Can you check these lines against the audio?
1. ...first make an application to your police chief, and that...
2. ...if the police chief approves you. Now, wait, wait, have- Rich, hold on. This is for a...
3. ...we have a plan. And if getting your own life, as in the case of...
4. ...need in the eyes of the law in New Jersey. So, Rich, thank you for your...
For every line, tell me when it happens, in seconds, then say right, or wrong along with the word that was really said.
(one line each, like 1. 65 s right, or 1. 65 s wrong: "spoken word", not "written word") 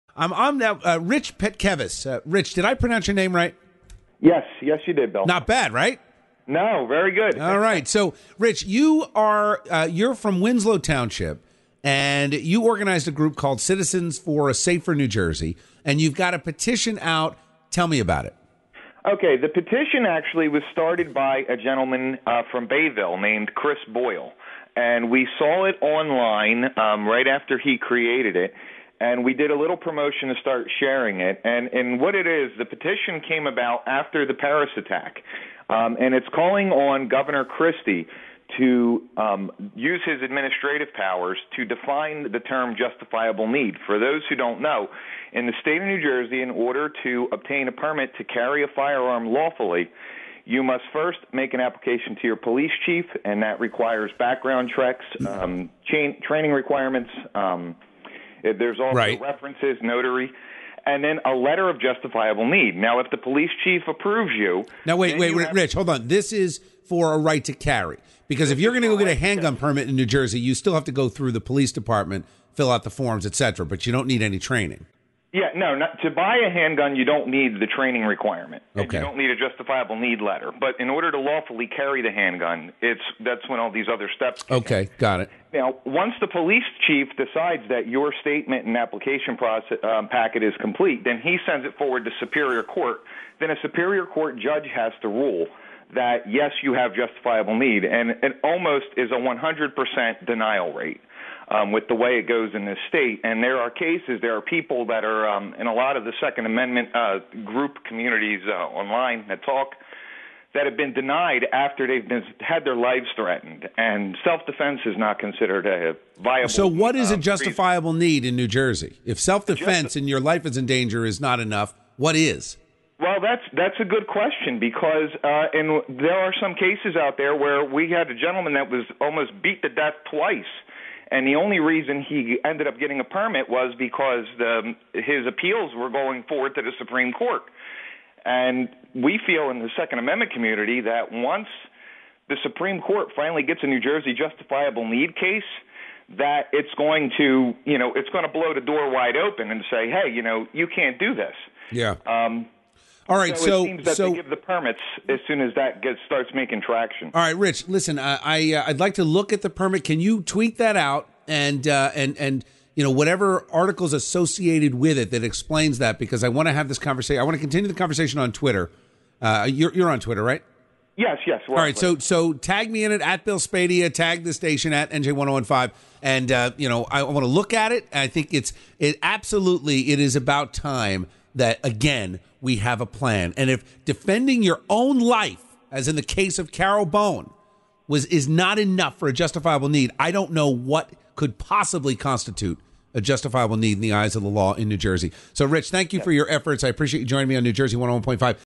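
1. 50 s right
2. 63 s right
3. 182 s wrong: "defending", not "getting"
4. 193 s right.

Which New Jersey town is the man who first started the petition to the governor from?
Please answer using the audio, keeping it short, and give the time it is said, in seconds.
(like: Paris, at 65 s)
Bayville, at 22 s.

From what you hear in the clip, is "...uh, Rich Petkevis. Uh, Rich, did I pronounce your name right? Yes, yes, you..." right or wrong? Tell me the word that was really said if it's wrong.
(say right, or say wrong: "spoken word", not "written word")
right.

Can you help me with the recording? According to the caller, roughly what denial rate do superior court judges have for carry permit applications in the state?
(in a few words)
100%.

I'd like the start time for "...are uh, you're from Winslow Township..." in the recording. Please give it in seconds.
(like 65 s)
9 s.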